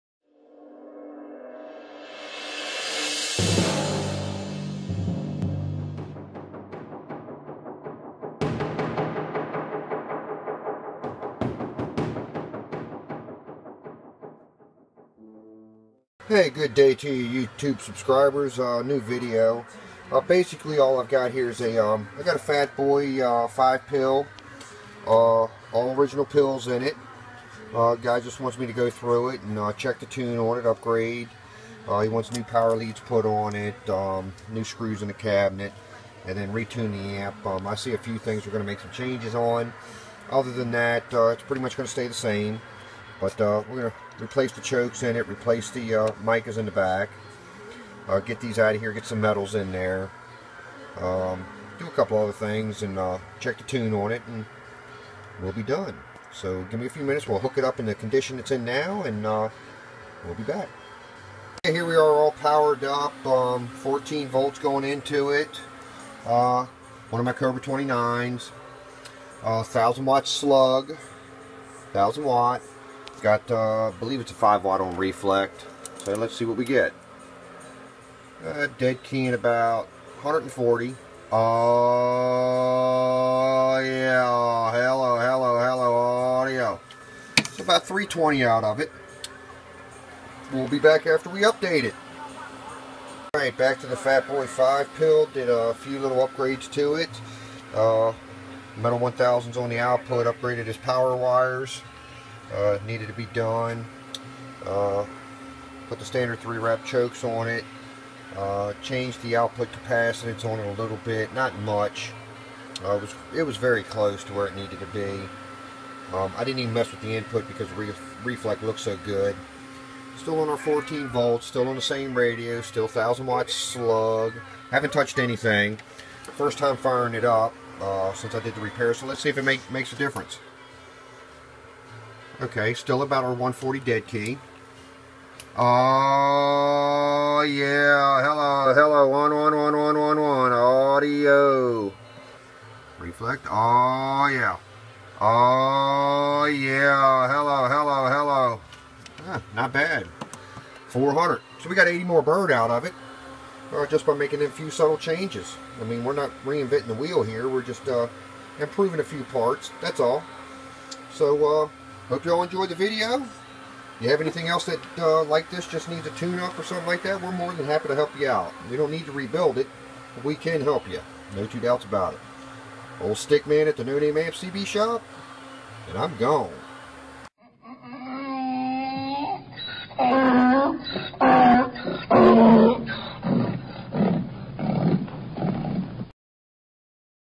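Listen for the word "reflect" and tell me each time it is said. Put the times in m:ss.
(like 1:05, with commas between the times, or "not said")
1:14, 1:58, 2:22.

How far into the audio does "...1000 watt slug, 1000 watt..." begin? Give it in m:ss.
1:09.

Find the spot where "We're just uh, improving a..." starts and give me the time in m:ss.
2:37.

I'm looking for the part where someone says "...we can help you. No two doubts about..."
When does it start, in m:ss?
2:50.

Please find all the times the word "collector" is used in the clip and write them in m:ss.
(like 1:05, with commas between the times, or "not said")
not said.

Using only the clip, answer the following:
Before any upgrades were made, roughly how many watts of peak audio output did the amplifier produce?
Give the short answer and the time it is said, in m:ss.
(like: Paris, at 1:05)
320, at 1:27.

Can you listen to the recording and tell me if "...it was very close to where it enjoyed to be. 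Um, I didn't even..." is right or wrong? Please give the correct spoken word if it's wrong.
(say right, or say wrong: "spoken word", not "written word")
wrong: "needed", not "enjoyed".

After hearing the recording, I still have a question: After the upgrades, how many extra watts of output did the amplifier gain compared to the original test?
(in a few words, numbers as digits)
80.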